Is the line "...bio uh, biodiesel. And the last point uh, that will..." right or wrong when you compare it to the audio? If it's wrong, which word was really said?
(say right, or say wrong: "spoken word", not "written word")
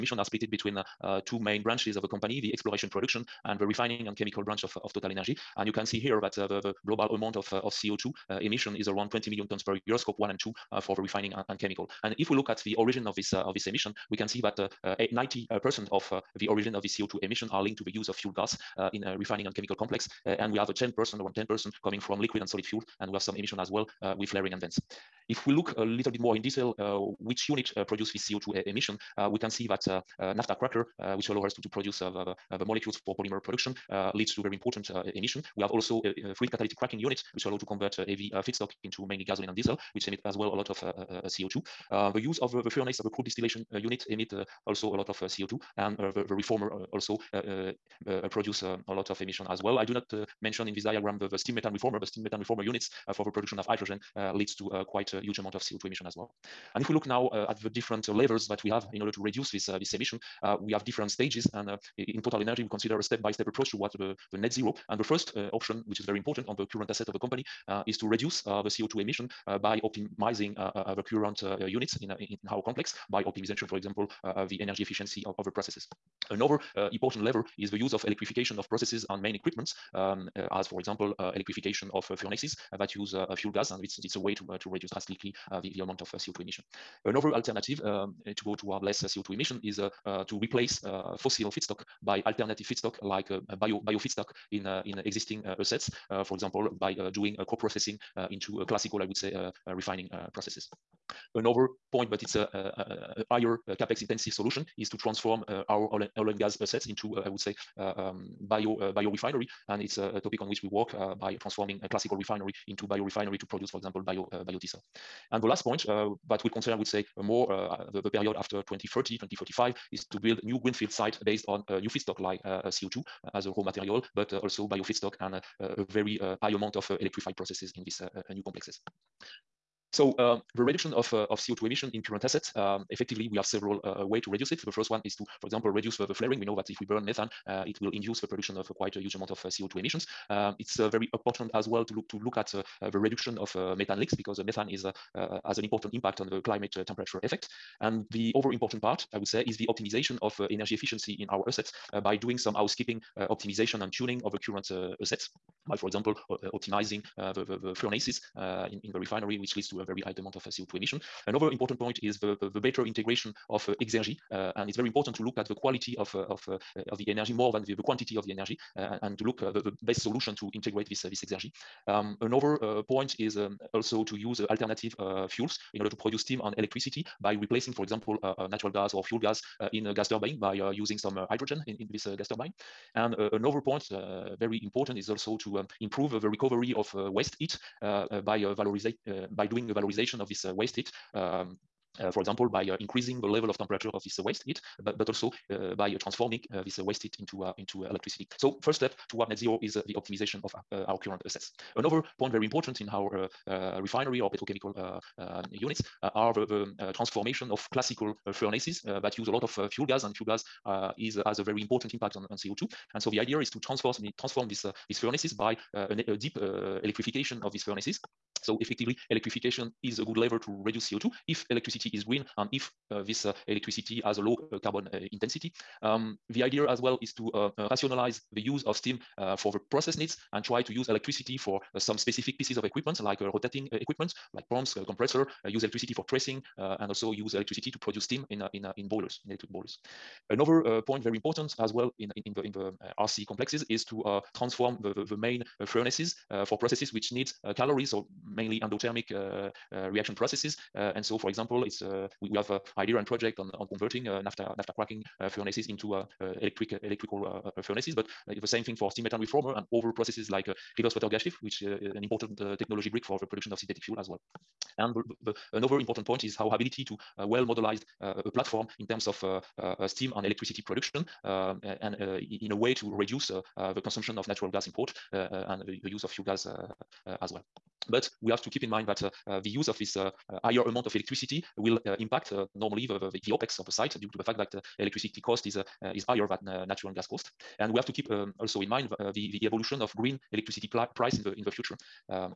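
right.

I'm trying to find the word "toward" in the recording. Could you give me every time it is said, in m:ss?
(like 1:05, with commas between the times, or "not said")
1:03, 1:28, 3:19.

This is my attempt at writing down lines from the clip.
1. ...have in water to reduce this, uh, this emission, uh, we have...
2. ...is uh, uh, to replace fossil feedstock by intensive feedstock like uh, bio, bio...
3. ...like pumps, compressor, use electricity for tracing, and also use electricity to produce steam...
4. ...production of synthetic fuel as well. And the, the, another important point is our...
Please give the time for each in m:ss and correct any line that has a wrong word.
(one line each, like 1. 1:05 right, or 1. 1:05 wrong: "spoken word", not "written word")
1. 0:58 wrong: "order", not "water"
2. 1:29 wrong: "alternative", not "intensive"
3. 3:54 right
4. 4:23 right.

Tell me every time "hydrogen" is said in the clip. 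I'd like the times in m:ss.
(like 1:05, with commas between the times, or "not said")
0:53, 3:01.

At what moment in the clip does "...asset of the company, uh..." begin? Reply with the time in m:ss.
1:06.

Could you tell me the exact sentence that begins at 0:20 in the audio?
Uh, and we have a 10%, around 10% coming from liquid and solid fuel.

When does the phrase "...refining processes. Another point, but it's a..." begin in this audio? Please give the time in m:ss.
1:39.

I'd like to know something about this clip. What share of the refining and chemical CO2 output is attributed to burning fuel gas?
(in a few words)
90%.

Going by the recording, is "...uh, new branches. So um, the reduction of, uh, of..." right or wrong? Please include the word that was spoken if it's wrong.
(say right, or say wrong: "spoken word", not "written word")
wrong: "complexes", not "branches".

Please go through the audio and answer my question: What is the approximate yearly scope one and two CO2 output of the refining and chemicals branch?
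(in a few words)
20 million tons.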